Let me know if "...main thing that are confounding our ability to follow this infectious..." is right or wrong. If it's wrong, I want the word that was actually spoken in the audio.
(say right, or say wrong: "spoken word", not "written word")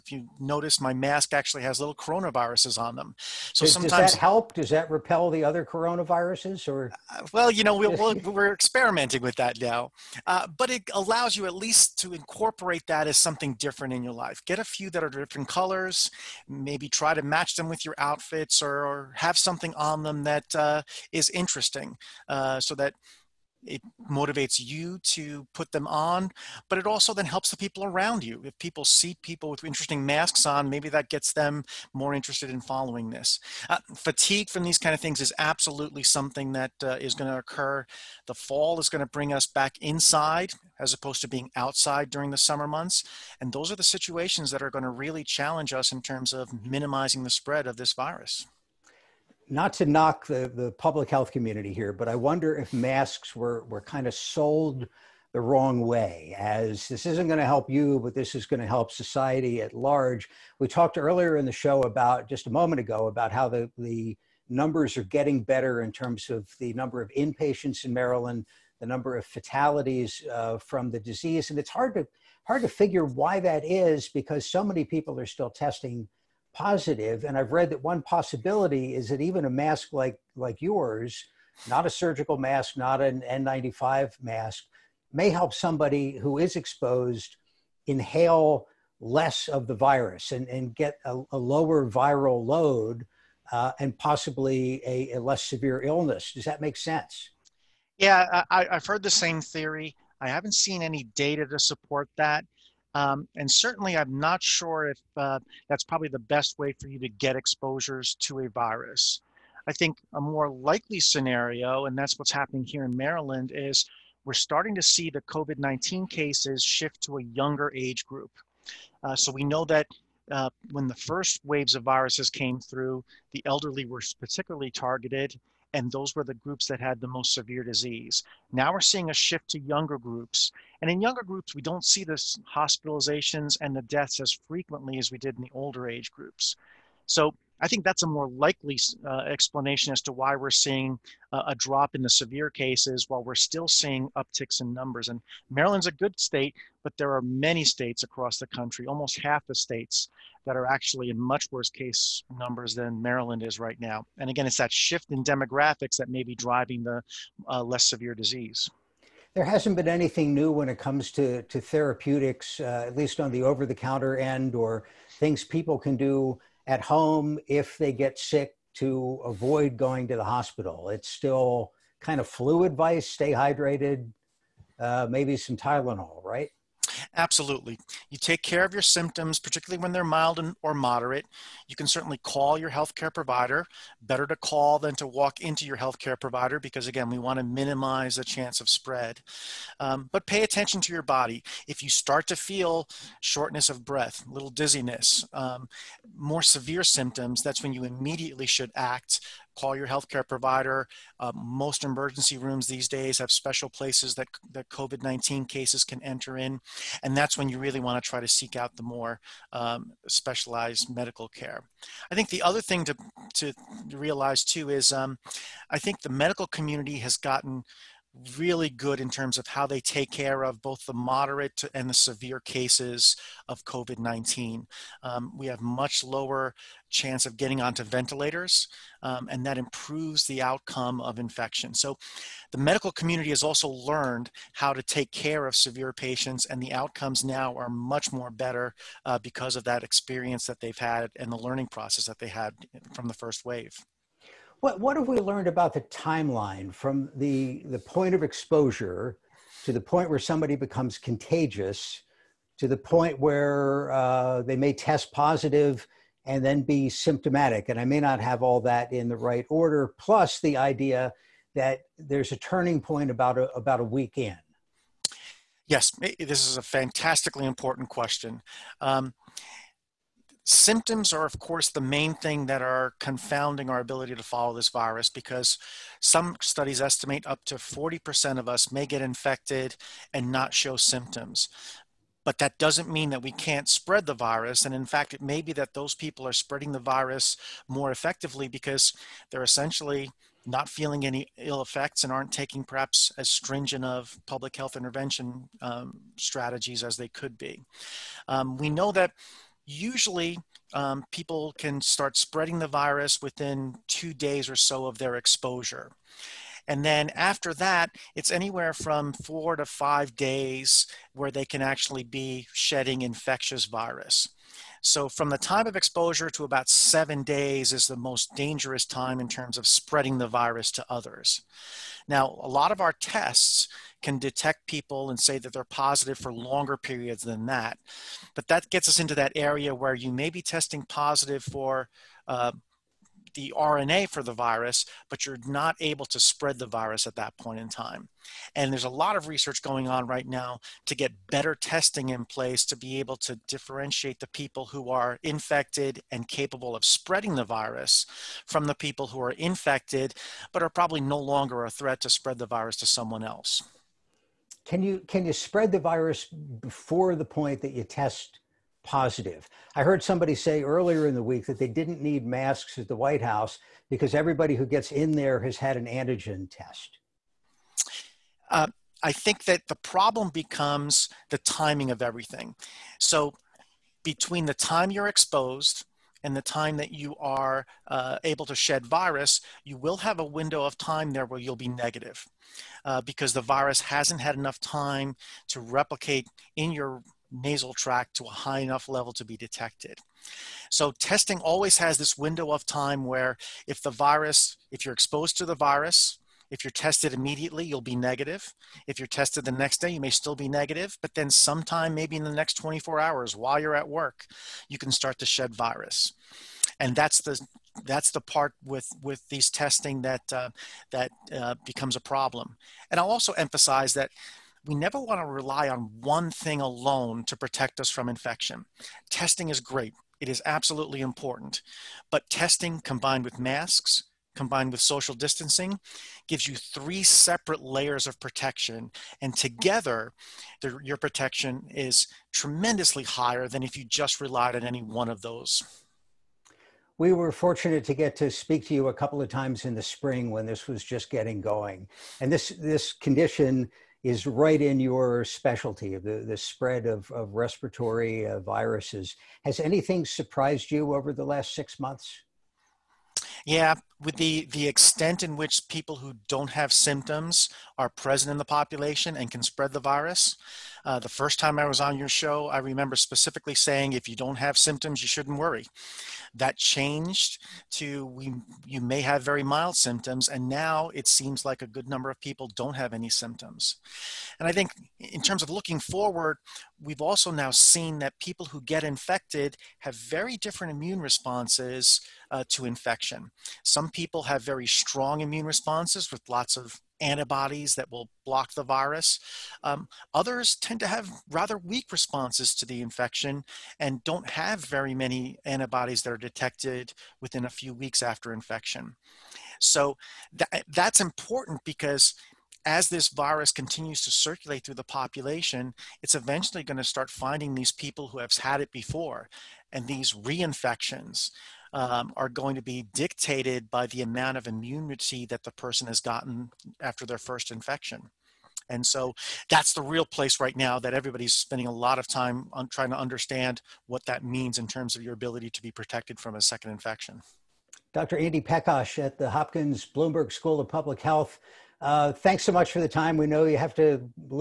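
wrong: "virus", not "infectious".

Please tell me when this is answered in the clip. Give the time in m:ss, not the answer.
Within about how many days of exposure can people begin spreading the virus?
5:03.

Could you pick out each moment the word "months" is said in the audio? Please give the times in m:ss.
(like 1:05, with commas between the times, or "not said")
0:42, 7:31.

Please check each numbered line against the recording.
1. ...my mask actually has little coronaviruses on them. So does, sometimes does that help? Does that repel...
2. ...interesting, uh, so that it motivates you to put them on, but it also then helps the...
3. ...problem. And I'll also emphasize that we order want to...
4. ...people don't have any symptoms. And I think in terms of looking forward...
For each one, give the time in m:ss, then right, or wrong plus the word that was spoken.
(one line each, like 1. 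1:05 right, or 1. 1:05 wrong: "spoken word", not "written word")
1. 0:00 right
2. 0:21 right
3. 6:52 wrong: "never", not "order"
4. 7:52 right.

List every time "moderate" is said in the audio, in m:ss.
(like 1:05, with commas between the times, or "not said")
3:00, 3:40.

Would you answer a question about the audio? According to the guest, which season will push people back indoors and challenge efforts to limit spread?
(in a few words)
the fall.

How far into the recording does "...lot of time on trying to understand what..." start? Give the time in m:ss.
8:41.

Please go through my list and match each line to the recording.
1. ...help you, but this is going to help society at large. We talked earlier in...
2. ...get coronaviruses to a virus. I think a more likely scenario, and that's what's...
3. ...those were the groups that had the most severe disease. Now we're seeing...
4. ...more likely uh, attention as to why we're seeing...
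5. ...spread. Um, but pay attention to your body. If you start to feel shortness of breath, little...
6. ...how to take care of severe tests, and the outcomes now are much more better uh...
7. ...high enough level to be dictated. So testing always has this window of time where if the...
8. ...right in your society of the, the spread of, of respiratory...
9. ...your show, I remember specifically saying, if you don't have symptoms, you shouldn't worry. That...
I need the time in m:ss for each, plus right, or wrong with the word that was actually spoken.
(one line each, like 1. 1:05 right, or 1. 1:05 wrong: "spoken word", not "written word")
1. 0:57 right
2. 1:47 wrong: "exposures", not "coronaviruses"
3. 2:05 right
4. 2:18 wrong: "explanation", not "attention"
5. 3:08 right
6. 3:54 wrong: "patients", not "tests"
7. 6:28 wrong: "detected", not "dictated"
8. 7:24 wrong: "specialty", not "society"
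9. 7:41 right.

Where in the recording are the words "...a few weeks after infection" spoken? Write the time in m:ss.
8:17.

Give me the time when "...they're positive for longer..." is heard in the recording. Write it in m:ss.
5:25.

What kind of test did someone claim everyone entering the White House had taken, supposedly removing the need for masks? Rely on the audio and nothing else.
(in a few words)
antigen test.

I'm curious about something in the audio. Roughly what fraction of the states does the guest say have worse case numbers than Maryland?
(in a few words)
almost half.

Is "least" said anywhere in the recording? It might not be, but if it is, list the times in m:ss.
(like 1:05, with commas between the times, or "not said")
0:11, 2:42.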